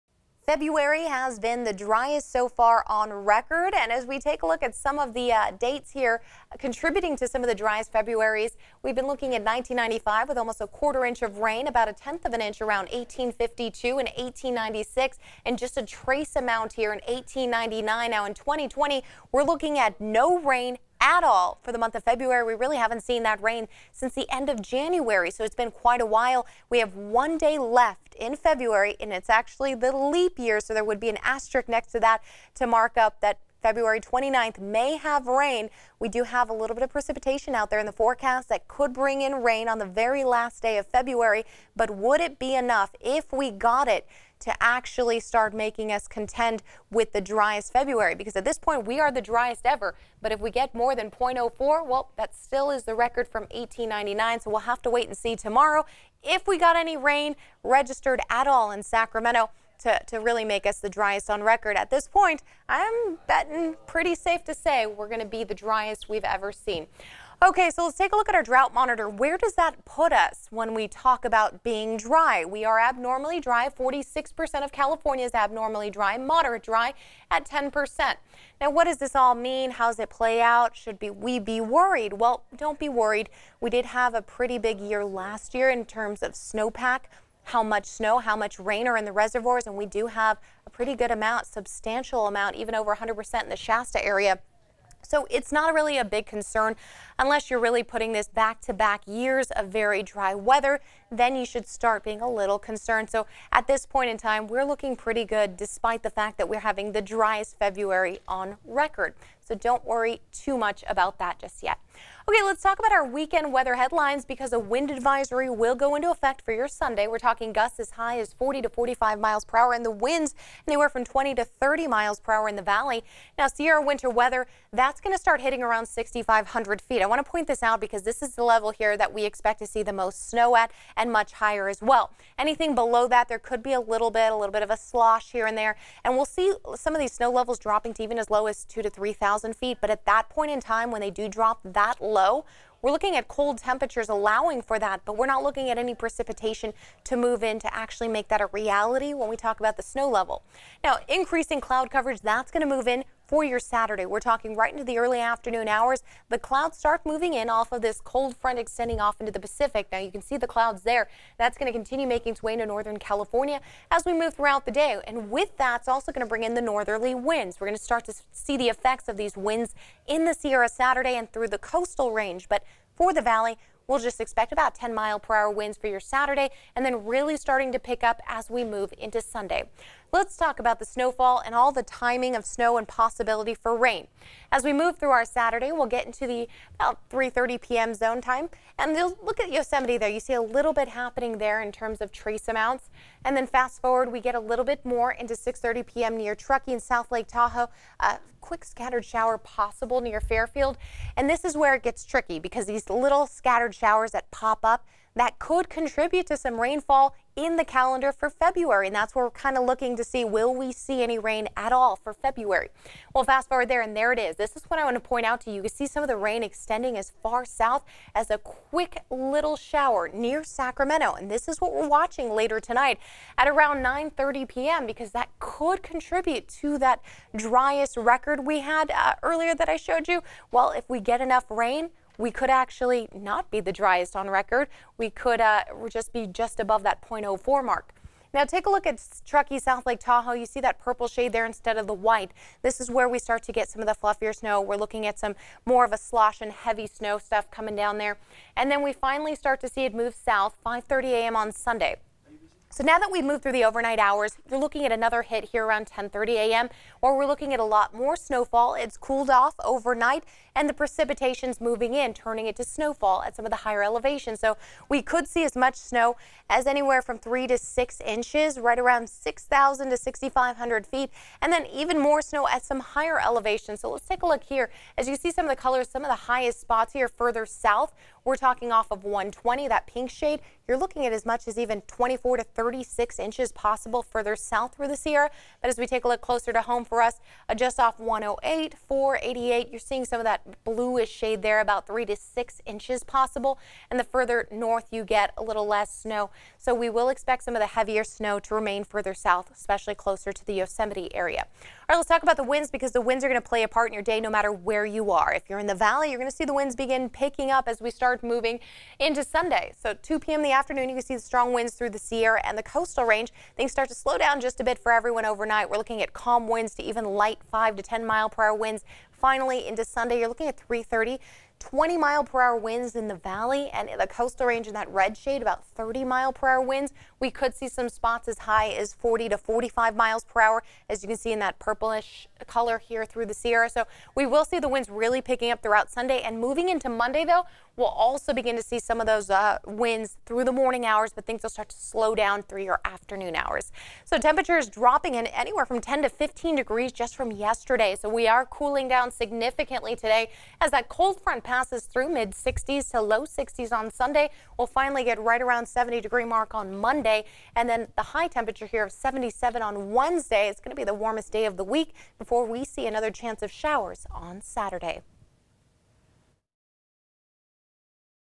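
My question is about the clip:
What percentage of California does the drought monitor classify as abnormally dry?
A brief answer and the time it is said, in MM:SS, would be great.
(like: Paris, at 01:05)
46%, at 01:13.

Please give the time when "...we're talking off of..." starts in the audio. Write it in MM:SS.
04:38.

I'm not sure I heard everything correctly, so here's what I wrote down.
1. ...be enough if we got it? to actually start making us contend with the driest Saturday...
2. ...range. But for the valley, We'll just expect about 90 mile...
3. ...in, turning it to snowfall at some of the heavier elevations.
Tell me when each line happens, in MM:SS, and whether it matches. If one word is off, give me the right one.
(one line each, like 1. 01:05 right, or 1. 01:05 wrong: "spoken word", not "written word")
1. 00:42 wrong: "February", not "Saturday"
2. 02:52 wrong: "10", not "90"
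3. 04:21 wrong: "higher", not "heavier".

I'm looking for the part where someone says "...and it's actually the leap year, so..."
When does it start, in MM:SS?
00:28.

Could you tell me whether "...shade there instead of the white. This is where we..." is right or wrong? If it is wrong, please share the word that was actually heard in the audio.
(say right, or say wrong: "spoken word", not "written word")
right.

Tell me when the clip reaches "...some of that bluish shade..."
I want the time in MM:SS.
04:50.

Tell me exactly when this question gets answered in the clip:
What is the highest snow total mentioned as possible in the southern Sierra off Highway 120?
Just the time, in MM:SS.
04:42.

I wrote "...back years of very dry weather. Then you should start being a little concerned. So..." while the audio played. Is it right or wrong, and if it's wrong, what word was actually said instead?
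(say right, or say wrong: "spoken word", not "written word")
right.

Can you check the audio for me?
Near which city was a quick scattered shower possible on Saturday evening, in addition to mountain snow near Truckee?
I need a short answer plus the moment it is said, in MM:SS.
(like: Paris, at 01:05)
Fairfield, at 03:20.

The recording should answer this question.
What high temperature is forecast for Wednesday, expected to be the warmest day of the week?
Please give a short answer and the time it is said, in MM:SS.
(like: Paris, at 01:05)
77, at 05:58.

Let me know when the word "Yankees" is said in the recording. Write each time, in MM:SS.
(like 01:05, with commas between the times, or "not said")
not said.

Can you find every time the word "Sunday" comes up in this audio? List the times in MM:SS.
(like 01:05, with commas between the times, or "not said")
01:56, 02:59, 04:11, 05:09, 05:19, 05:35, 05:53.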